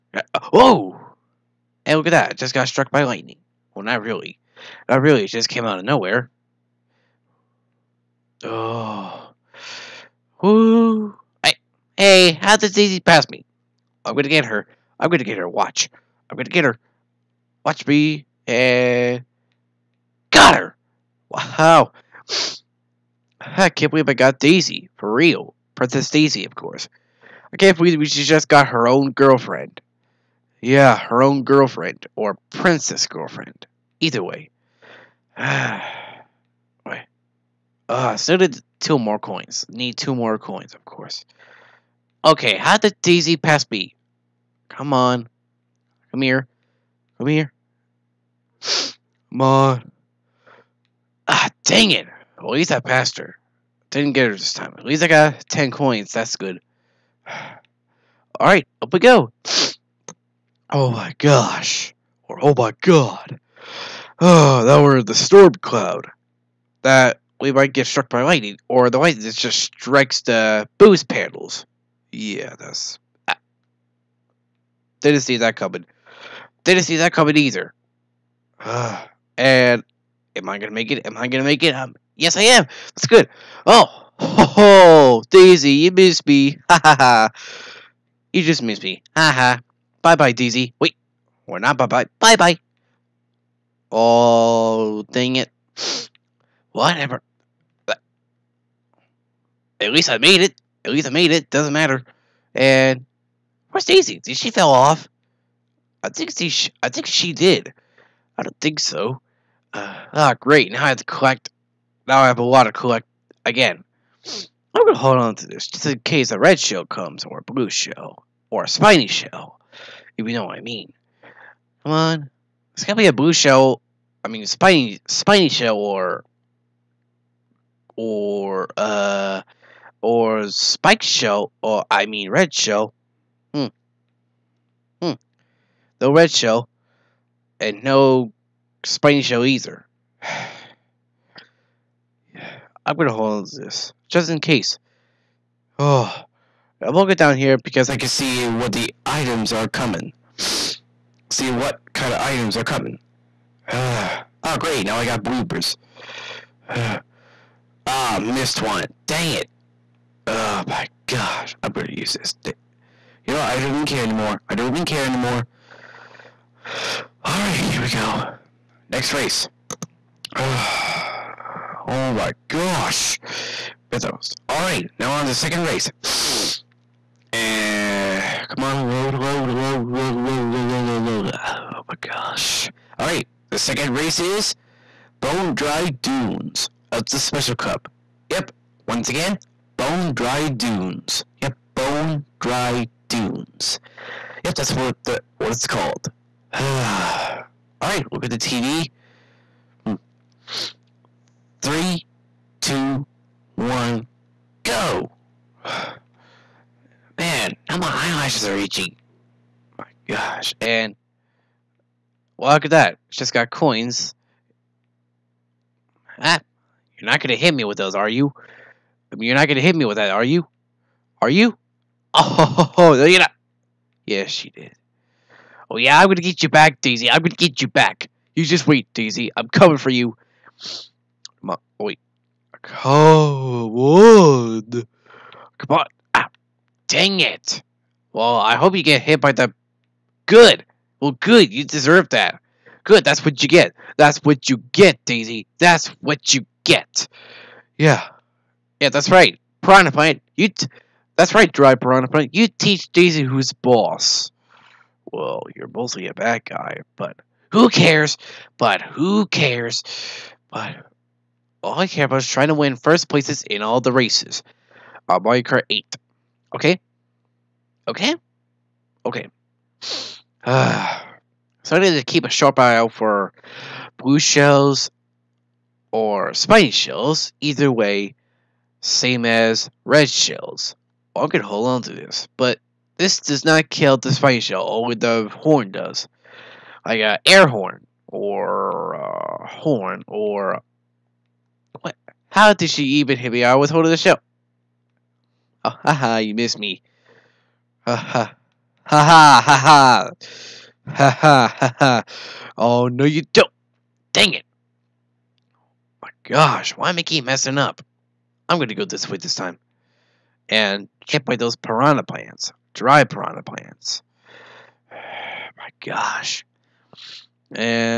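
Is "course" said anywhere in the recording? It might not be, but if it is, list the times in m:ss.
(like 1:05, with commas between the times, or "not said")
0:26, 0:40.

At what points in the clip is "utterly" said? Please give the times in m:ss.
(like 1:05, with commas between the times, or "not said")
not said.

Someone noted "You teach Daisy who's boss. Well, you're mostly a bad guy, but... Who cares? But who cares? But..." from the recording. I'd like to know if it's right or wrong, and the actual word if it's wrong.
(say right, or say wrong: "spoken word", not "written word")
right.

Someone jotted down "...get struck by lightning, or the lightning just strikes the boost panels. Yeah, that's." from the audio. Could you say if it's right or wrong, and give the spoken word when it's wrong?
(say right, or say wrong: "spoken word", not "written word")
right.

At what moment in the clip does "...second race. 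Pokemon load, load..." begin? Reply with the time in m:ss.
2:55.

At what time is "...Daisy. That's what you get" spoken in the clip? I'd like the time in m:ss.
4:05.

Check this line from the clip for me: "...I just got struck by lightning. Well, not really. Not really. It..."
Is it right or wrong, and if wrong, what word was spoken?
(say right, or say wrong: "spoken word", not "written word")
right.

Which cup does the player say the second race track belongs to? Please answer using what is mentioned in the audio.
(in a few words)
Special Cup.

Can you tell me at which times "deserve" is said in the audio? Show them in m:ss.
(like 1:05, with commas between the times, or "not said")
4:01.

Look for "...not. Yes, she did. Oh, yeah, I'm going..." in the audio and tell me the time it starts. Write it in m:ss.
3:43.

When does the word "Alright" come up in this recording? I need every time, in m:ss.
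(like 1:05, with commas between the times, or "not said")
0:58, 3:02, 3:16.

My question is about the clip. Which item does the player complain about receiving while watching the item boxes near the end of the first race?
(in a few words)
Bloopers.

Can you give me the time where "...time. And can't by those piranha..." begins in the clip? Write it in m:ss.
5:09.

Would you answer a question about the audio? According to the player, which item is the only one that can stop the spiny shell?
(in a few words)
The horn.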